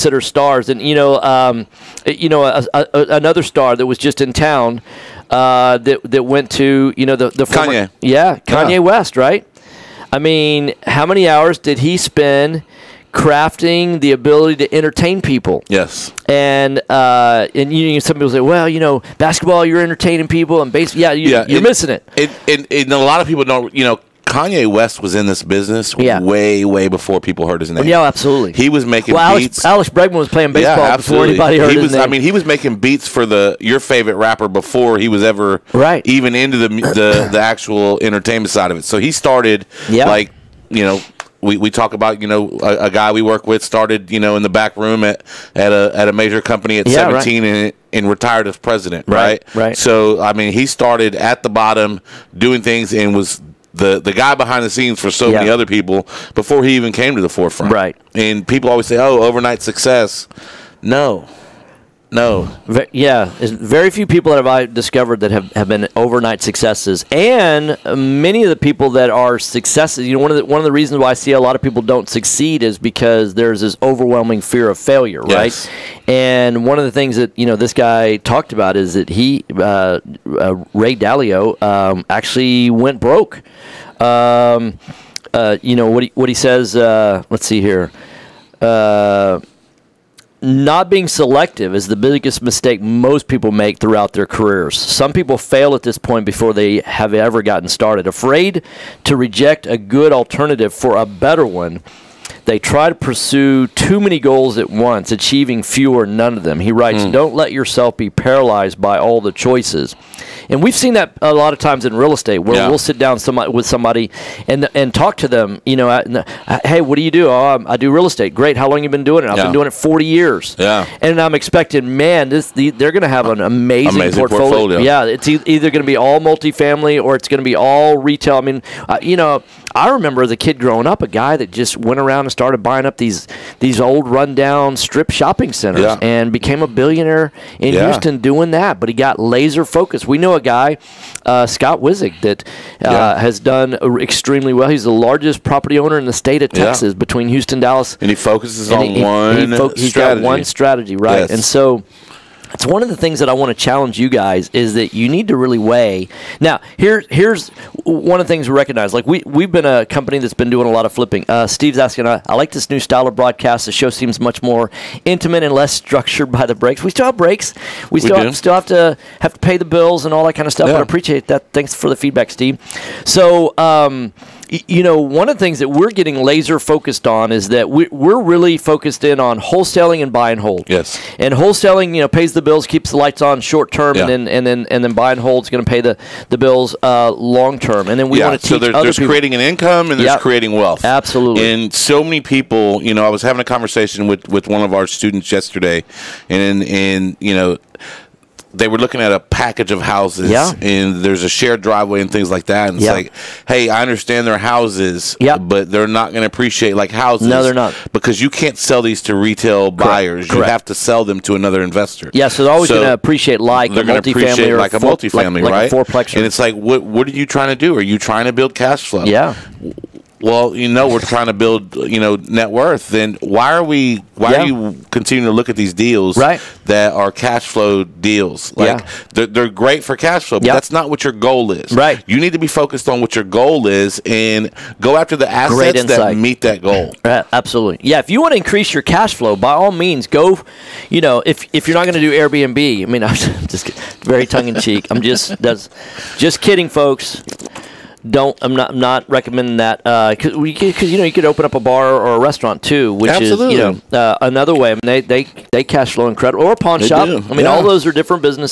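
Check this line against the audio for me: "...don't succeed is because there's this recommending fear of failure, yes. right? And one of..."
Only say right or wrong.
wrong.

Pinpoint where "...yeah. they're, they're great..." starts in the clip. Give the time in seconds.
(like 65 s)
228 s.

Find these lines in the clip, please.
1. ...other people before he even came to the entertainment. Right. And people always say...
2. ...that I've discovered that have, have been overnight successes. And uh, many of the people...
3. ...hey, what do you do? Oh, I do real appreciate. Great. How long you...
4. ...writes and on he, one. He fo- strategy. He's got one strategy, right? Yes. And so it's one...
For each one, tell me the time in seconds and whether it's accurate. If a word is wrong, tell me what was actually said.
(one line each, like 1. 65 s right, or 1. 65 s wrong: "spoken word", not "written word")
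1. 55 s wrong: "forefront", not "entertainment"
2. 64 s right
3. 116 s wrong: "estate", not "appreciate"
4. 148 s wrong: "focuses", not "writes".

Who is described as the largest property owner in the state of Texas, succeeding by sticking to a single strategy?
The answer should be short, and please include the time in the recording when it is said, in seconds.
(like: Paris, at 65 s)
Scott Wizig, at 141 s.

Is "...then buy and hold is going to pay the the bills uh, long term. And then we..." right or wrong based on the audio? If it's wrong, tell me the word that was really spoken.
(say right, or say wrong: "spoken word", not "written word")
right.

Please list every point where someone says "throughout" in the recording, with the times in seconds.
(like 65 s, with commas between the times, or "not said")
93 s.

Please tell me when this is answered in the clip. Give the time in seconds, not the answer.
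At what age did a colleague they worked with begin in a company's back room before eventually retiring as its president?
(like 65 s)
46 s.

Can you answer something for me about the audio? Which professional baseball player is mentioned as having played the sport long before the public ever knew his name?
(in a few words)
Alex Bregman.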